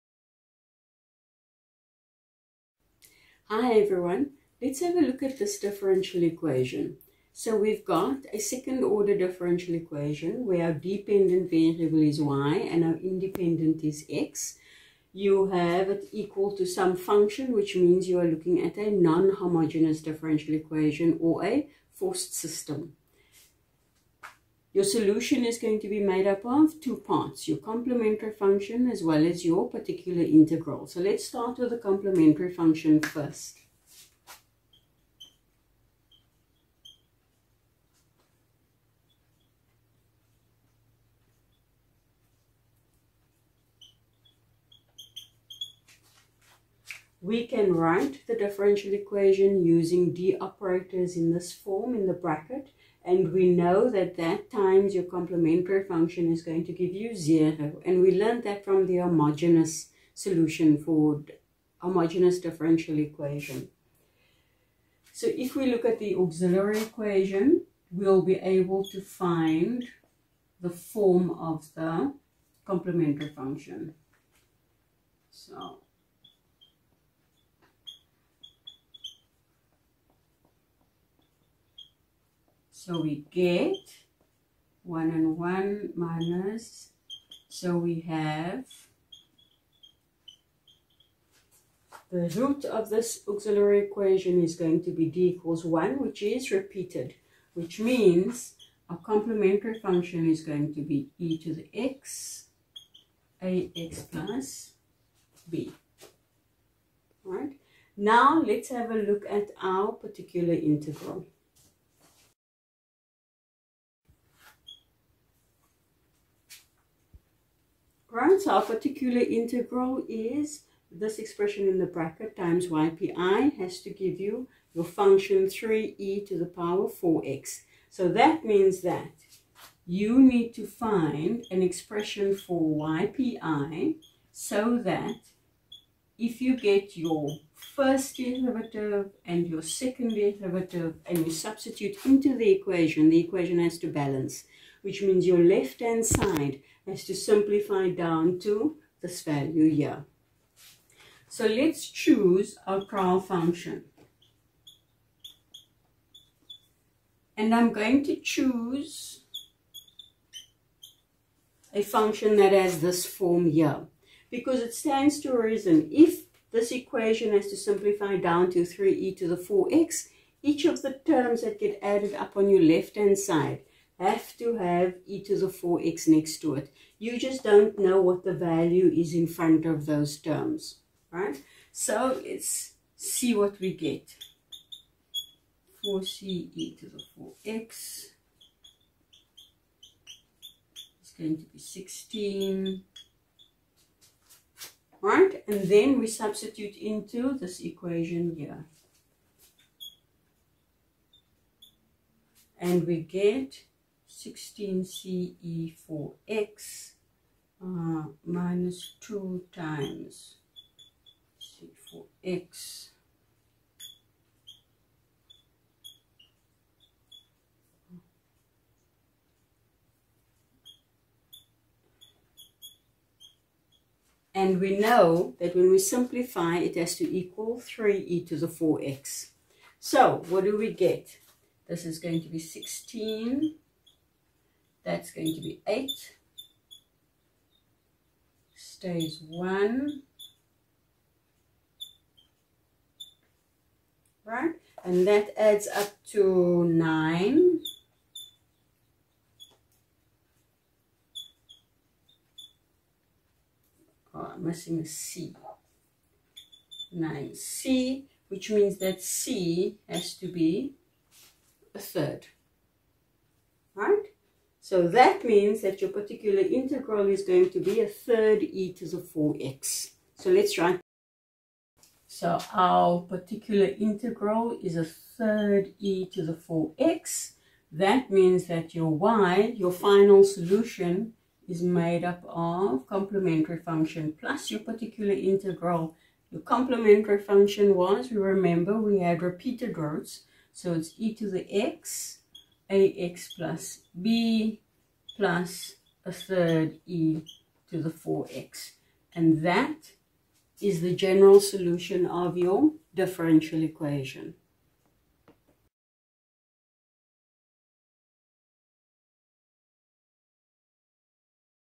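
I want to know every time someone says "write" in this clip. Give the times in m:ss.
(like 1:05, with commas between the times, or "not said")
0:47, 4:30.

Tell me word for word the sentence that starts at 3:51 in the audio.
This is going to be 16 that's going to be 8.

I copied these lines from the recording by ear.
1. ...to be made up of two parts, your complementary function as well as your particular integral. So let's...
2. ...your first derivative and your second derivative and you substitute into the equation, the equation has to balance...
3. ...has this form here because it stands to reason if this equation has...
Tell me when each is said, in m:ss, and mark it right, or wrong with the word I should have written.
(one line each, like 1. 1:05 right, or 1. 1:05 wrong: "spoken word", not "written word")
1. 0:25 right
2. 2:16 right
3. 2:42 right.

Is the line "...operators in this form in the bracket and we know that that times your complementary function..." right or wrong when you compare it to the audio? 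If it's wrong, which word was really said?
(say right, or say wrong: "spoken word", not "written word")
right.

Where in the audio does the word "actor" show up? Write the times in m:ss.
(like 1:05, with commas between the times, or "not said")
not said.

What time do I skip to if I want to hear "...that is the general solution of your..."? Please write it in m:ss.
4:59.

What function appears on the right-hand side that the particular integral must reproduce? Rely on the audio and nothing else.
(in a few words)
3e^(4x).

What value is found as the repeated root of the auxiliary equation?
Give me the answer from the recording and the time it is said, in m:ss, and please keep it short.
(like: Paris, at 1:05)
1, at 1:35.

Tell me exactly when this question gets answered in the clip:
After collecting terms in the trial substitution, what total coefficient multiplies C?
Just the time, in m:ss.
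4:16.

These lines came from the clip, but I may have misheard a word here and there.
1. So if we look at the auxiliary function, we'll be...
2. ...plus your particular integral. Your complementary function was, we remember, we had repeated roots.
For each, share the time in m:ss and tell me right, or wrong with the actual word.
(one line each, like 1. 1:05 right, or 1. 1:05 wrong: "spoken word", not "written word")
1. 1:05 wrong: "equation", not "function"
2. 4:44 right.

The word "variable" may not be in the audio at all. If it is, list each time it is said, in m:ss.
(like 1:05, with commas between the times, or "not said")
0:11.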